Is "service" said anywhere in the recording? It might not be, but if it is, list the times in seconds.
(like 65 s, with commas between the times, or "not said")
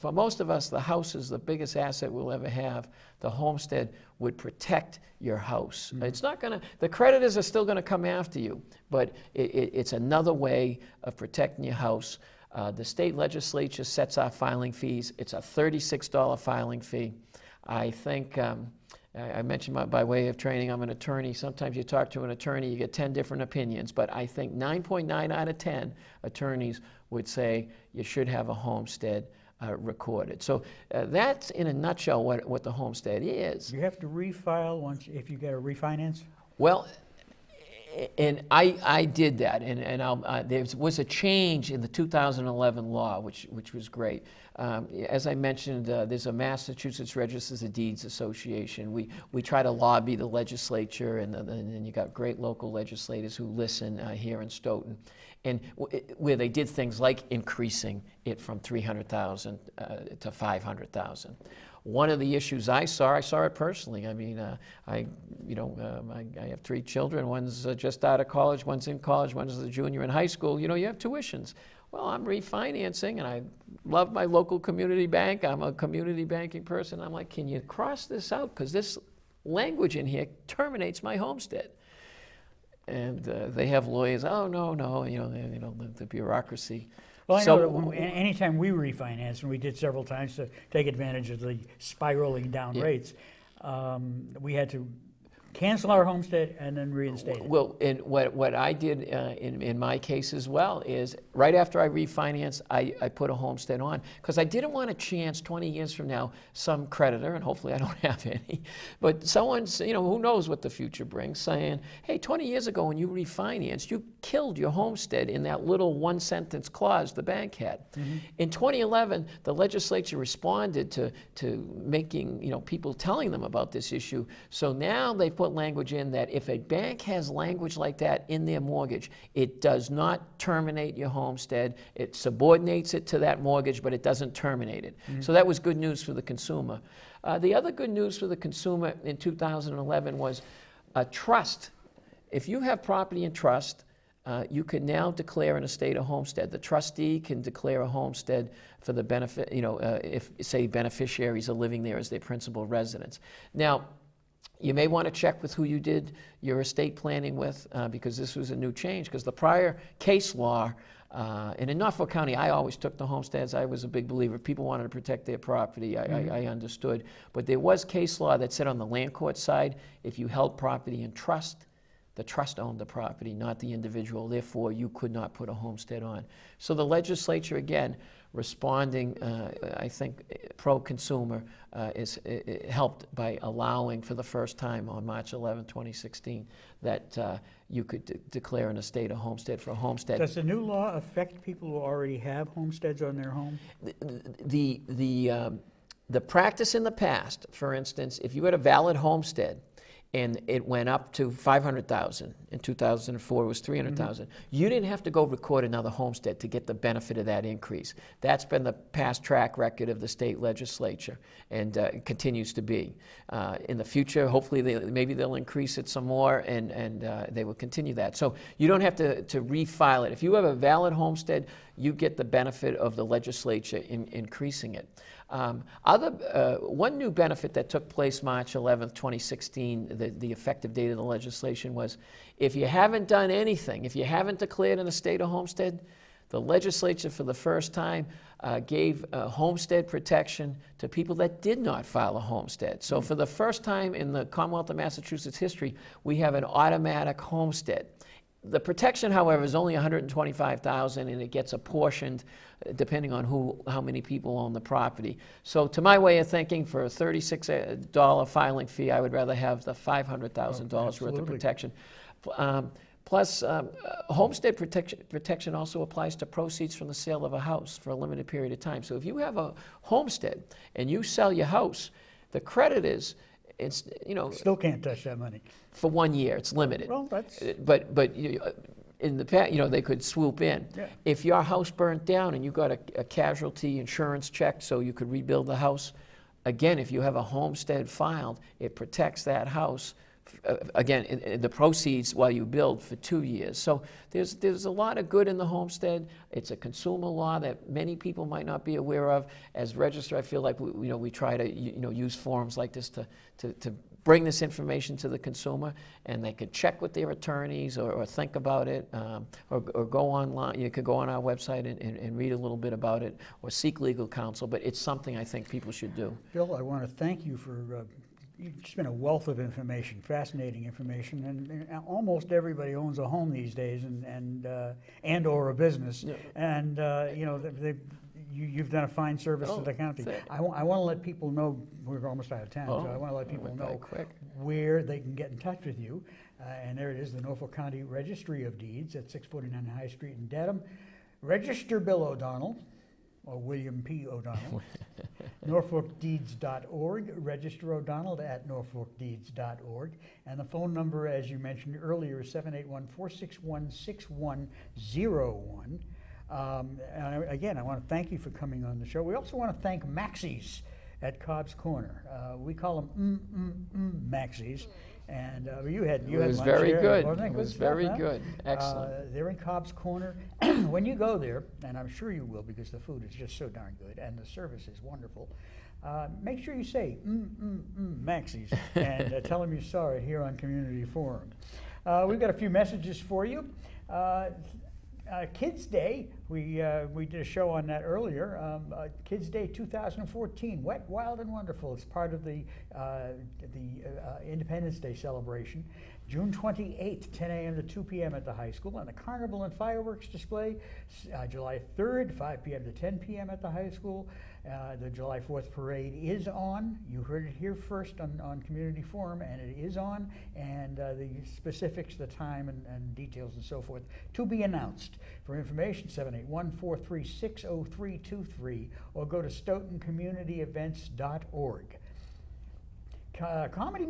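329 s, 374 s.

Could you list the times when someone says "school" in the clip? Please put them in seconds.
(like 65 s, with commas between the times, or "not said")
70 s, 398 s, 403 s.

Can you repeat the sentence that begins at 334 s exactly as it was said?
where they can get in touch with you.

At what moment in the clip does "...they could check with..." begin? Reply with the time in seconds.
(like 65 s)
306 s.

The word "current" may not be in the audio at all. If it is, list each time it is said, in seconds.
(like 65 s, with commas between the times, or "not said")
not said.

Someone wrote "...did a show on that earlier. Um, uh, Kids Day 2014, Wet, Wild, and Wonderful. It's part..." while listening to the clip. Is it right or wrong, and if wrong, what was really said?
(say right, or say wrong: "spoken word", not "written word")
right.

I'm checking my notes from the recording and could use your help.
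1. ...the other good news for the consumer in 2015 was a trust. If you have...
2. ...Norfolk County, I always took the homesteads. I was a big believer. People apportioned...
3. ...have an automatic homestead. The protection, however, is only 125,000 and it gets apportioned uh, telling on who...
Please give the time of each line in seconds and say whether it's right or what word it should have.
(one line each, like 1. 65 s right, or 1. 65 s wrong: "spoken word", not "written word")
1. 137 s wrong: "2011", not "2015"
2. 161 s wrong: "wanted", not "apportioned"
3. 246 s wrong: "depending", not "telling".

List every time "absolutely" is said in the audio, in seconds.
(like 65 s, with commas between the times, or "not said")
not said.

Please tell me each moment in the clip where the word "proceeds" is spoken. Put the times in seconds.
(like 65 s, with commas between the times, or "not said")
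266 s, 291 s.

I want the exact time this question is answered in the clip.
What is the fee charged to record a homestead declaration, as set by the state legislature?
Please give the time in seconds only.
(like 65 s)
15 s.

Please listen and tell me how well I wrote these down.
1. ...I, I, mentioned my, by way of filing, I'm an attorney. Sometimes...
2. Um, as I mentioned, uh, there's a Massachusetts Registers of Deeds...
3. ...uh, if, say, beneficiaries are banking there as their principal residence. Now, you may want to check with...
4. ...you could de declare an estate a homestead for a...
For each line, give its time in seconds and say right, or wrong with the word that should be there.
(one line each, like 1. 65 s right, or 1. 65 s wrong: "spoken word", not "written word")
1. 19 s wrong: "training", not "filing"
2. 44 s right
3. 149 s wrong: "living", not "banking"
4. 187 s right.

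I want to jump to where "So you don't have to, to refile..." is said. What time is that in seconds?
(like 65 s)
218 s.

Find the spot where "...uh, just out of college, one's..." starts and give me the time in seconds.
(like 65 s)
67 s.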